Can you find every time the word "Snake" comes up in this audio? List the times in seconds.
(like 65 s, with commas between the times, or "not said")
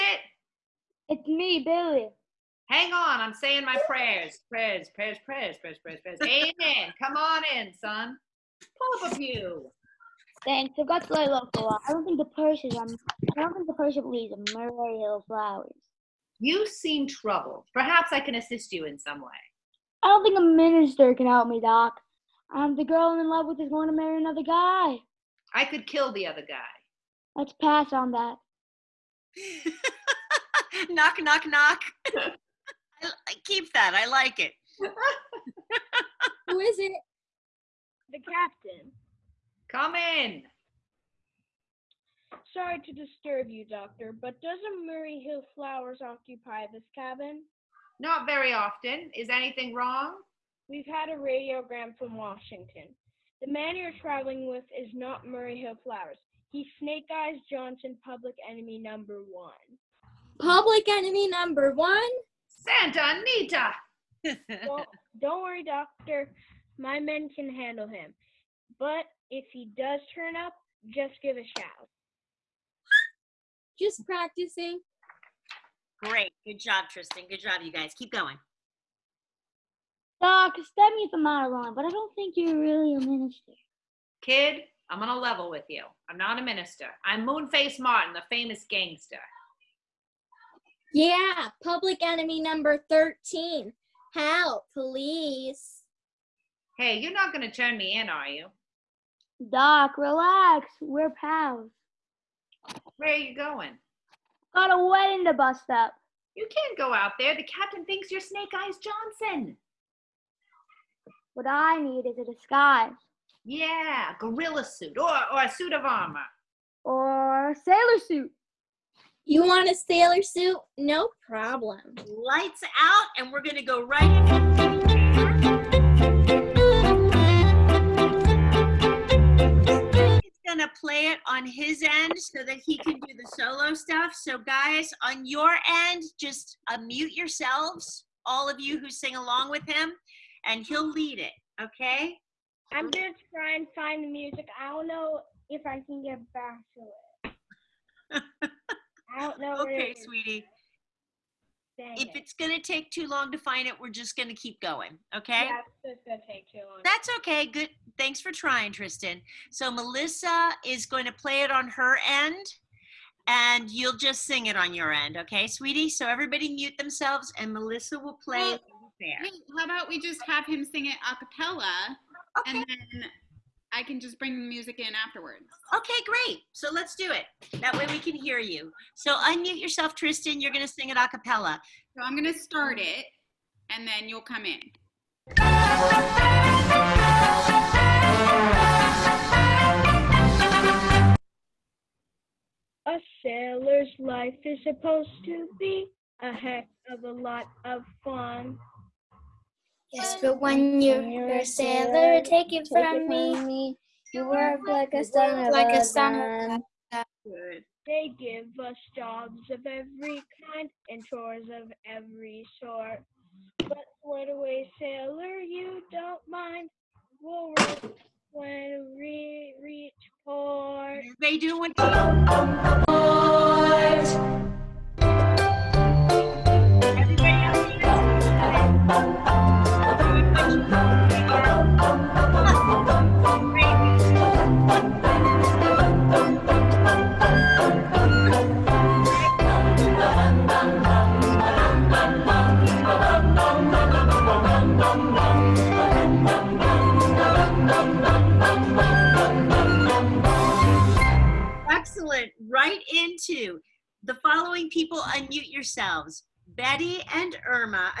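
56 s, 108 s.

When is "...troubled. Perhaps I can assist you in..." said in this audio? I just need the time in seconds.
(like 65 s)
17 s.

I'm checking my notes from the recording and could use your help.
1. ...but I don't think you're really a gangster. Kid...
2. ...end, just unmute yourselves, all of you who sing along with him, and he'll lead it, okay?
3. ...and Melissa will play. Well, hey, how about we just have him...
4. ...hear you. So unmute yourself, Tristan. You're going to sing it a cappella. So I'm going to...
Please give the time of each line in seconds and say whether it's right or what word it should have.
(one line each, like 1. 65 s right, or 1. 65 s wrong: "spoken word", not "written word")
1. 81 s wrong: "minister", not "gangster"
2. 135 s right
3. 167 s right
4. 178 s right.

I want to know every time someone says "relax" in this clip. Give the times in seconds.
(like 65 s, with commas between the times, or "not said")
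99 s.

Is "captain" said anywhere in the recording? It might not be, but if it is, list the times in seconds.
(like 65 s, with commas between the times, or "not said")
38 s, 107 s.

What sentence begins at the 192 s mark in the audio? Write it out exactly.
A sailor's life is supposed to be a heck of a lot of fun.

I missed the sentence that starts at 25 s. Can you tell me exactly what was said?
I could kill the other guy.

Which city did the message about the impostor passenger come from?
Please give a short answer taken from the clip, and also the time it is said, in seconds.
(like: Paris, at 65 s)
Washington, at 52 s.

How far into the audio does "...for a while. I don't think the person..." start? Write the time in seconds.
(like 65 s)
11 s.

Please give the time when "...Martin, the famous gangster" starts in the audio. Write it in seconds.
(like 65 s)
87 s.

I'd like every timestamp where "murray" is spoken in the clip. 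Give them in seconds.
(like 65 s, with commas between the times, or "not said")
14 s, 44 s, 55 s.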